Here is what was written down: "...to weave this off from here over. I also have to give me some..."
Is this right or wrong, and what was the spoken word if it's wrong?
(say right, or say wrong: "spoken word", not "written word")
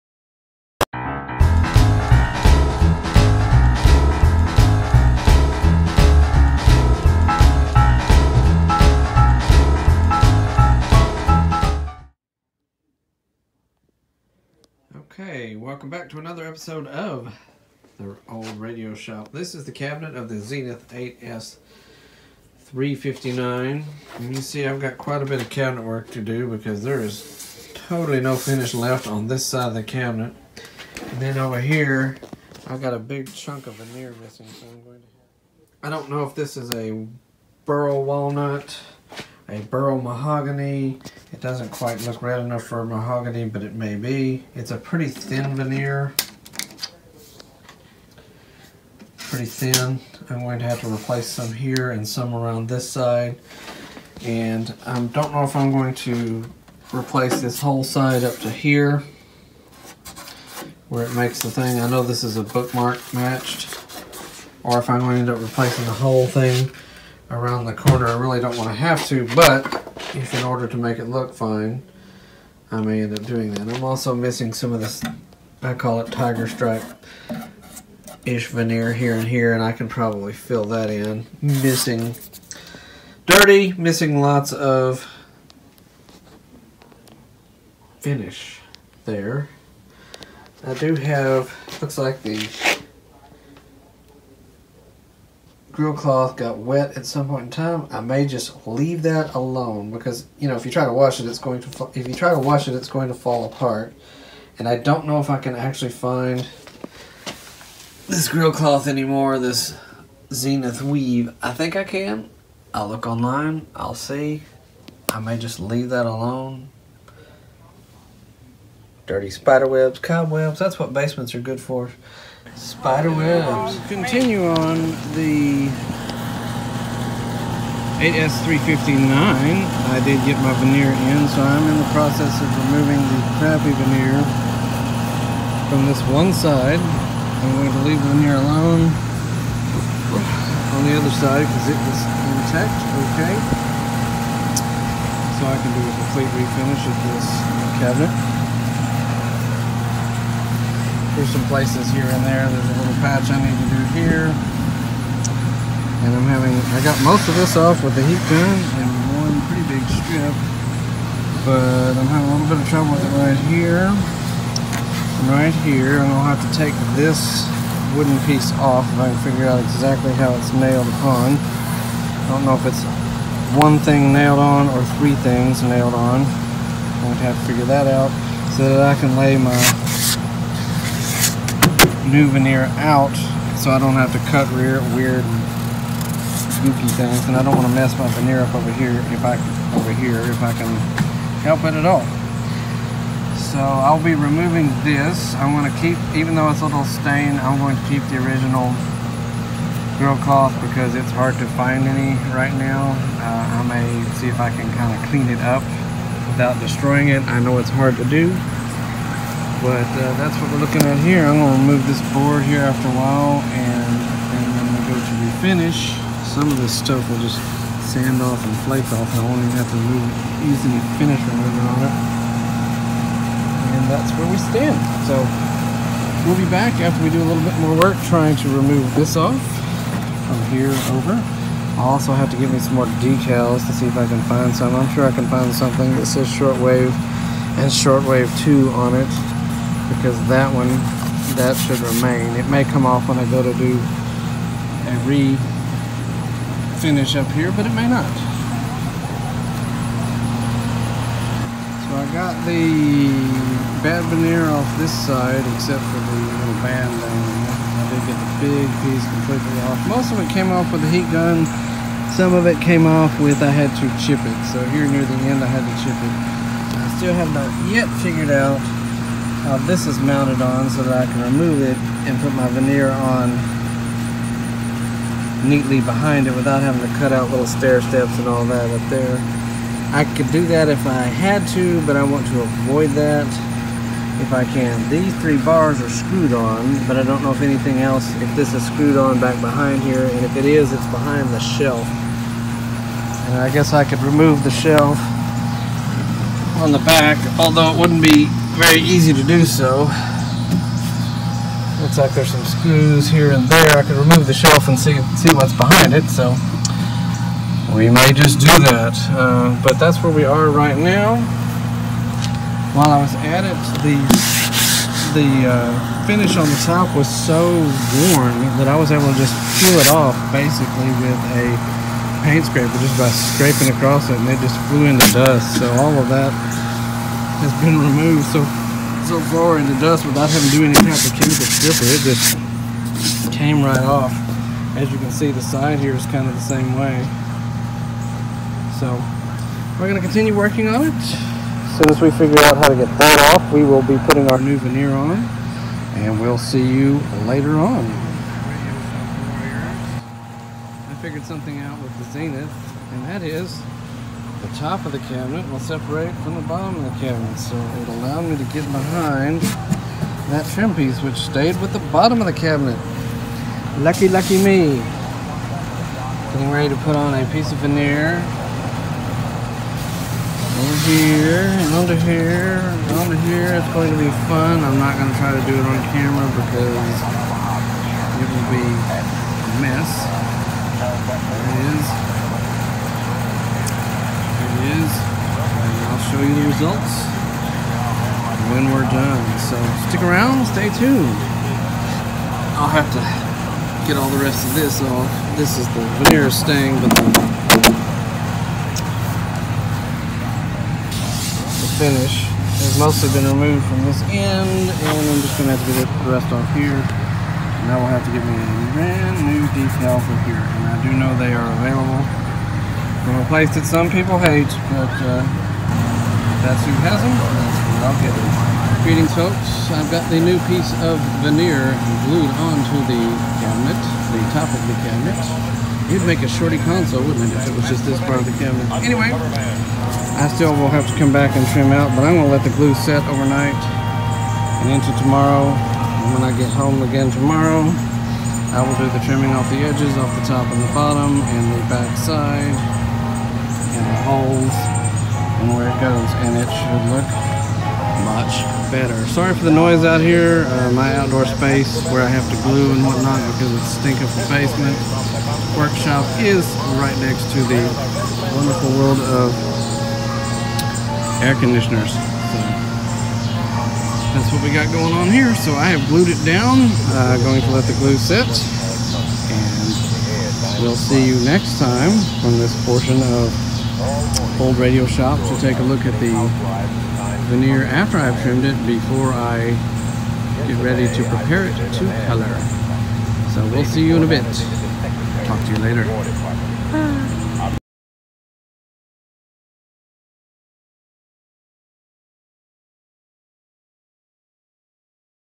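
wrong: "remove", not "weave".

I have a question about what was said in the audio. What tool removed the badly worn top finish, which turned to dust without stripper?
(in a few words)
paint scraper.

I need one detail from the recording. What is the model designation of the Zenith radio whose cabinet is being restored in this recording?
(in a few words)
8S 359.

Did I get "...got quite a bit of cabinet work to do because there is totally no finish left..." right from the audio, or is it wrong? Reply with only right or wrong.
right.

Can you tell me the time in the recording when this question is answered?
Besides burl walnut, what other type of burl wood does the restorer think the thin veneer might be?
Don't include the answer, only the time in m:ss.
0:39.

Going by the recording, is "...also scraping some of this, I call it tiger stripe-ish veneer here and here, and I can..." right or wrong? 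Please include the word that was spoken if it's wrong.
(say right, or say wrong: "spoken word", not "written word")
wrong: "missing", not "scraping".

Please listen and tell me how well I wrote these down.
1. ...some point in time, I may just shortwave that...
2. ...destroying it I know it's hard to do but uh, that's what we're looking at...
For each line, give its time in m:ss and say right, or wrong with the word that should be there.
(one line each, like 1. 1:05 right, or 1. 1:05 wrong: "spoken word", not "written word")
1. 1:37 wrong: "leave", not "shortwave"
2. 3:26 right.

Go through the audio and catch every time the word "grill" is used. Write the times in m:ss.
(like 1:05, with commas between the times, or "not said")
1:35, 1:48, 3:19.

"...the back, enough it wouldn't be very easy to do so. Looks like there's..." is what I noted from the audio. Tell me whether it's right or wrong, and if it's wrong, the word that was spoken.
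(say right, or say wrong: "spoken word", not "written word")
wrong: "although", not "enough".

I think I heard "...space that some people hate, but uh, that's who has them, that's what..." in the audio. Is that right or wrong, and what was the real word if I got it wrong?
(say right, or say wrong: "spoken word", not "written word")
wrong: "place", not "space".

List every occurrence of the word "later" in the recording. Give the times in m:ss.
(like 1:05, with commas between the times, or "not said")
5:47, 8:05.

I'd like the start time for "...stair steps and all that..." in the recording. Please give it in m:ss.
4:37.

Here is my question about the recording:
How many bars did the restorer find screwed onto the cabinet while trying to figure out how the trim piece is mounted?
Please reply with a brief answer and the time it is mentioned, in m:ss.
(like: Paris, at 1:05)
3, at 4:44.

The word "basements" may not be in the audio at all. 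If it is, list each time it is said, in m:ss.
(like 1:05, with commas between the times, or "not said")
2:00, 7:34.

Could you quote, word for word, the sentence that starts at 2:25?
So I can do a complete refinish of this cabinet through some places here and there.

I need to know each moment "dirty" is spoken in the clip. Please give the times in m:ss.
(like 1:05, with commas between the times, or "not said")
1:23, 1:59.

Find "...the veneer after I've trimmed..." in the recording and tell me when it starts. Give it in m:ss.
7:55.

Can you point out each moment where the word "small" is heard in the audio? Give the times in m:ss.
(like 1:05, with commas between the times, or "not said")
not said.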